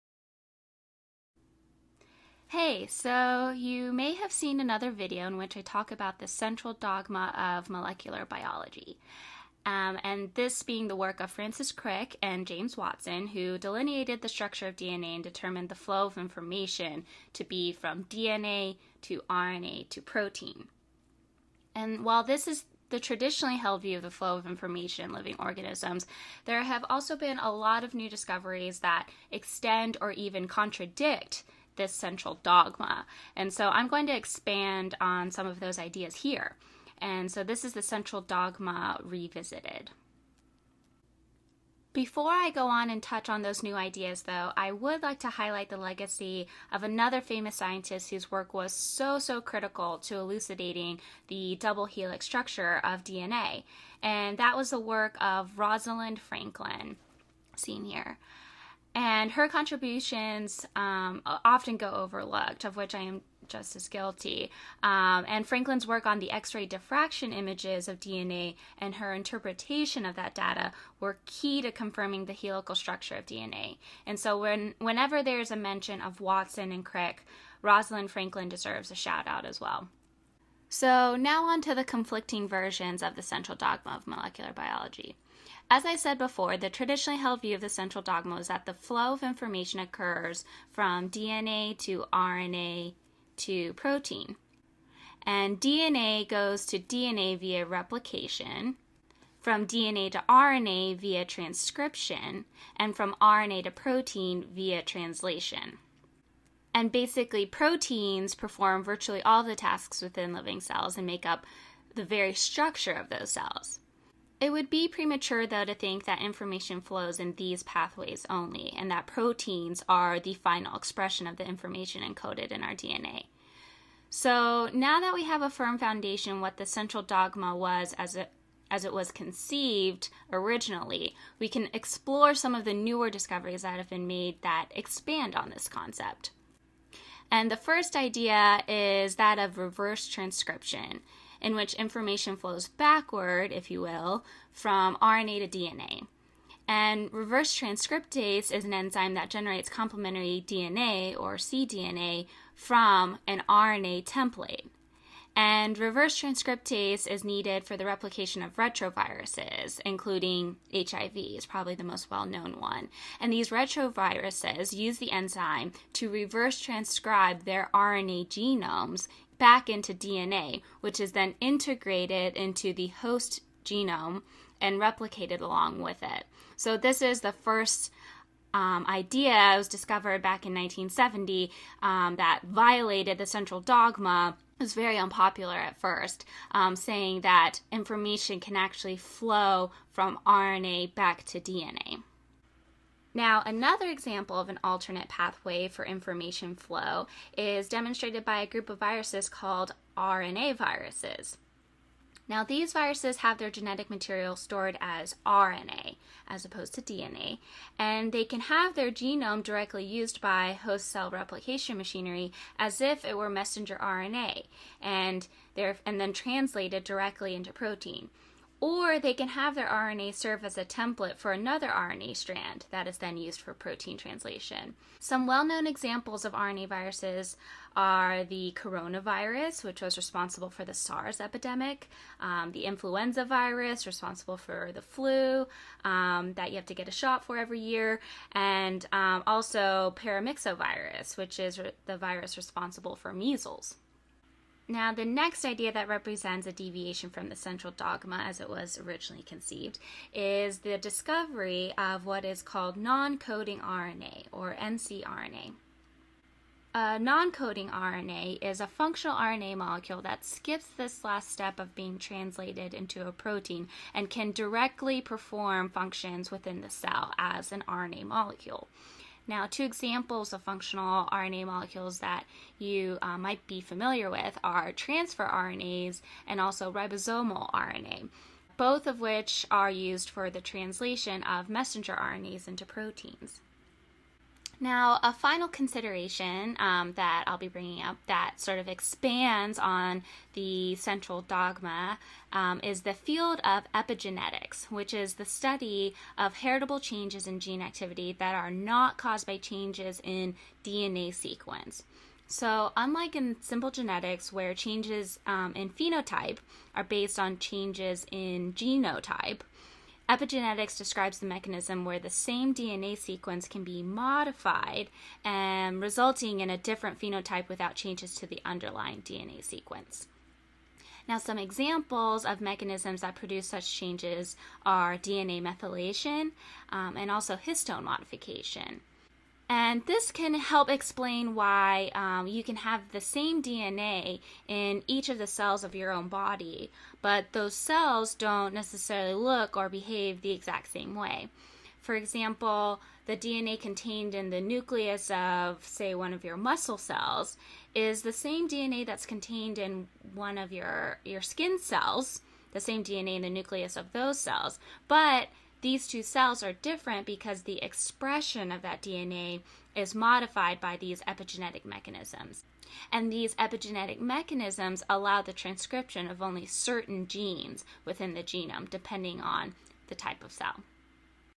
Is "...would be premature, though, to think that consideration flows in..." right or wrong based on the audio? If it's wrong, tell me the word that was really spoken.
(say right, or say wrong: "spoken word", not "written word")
wrong: "information", not "consideration".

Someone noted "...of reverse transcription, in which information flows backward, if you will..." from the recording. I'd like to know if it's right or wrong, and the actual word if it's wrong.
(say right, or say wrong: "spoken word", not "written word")
right.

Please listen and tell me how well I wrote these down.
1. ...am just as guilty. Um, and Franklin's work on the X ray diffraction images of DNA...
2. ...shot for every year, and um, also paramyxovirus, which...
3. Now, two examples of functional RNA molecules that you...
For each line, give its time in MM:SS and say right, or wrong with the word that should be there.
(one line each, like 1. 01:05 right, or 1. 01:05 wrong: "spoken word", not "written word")
1. 01:03 right
2. 03:56 right
3. 04:29 right.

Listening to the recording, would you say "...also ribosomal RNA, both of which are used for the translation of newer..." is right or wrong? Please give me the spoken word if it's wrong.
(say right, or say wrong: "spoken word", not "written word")
wrong: "messenger", not "newer".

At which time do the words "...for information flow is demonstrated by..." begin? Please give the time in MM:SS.
03:15.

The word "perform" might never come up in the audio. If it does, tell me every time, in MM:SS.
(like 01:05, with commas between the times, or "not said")
01:48, 04:25.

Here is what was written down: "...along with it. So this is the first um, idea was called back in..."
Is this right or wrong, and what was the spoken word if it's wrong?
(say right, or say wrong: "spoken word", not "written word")
wrong: "discovered", not "called".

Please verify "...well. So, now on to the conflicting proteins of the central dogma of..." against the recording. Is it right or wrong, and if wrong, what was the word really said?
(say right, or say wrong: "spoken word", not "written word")
wrong: "versions", not "proteins".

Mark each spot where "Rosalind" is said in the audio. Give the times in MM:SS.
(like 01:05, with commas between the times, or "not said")
00:55, 01:17.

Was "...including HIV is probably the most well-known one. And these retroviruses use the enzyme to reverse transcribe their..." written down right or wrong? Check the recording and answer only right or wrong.
right.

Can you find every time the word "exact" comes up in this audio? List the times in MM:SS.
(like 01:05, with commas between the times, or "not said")
05:40.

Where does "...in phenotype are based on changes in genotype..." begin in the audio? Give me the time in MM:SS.
05:05.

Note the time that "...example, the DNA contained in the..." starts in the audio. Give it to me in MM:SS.
05:41.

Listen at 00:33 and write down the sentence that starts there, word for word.
And so I'm going to expand on some of those ideas here.